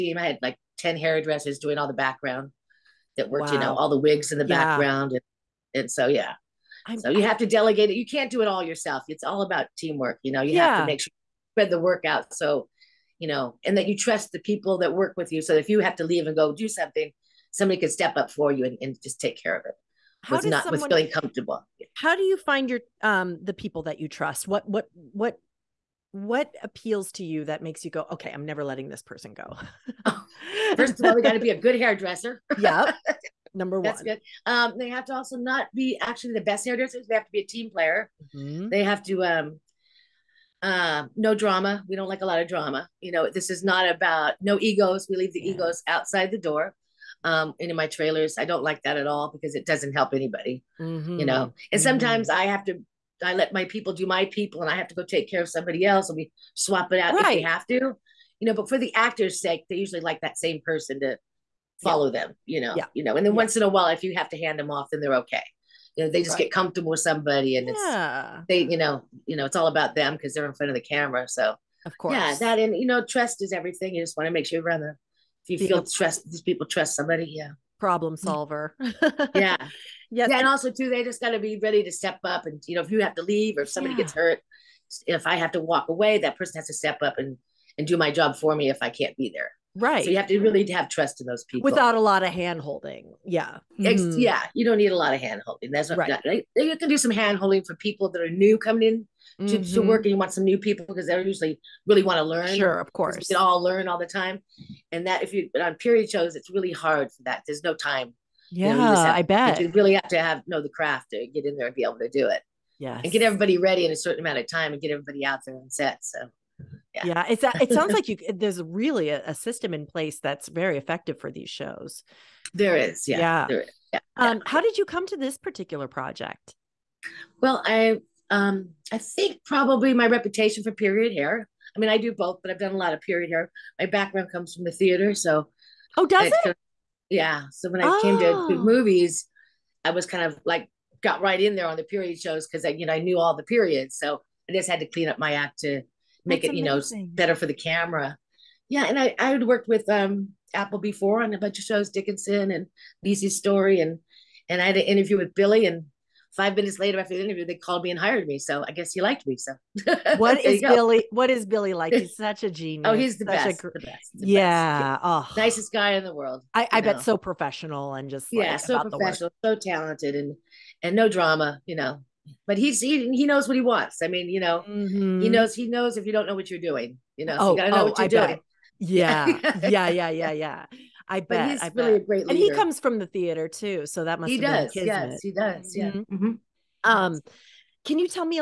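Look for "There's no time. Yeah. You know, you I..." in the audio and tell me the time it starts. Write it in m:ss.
1:47.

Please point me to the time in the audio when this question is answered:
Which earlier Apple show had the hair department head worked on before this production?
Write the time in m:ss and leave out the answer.
2:31.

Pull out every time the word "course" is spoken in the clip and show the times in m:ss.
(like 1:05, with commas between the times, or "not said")
1:11, 1:42.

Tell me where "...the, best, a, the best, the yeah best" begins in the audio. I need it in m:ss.
2:43.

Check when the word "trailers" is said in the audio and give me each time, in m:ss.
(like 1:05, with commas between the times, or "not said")
0:47.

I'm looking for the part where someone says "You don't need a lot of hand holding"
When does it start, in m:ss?
1:34.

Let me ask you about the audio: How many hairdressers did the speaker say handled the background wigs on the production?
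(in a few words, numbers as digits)
10.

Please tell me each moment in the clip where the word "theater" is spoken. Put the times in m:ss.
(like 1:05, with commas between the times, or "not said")
2:14, 3:03.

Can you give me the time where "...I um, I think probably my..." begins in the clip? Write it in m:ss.
2:07.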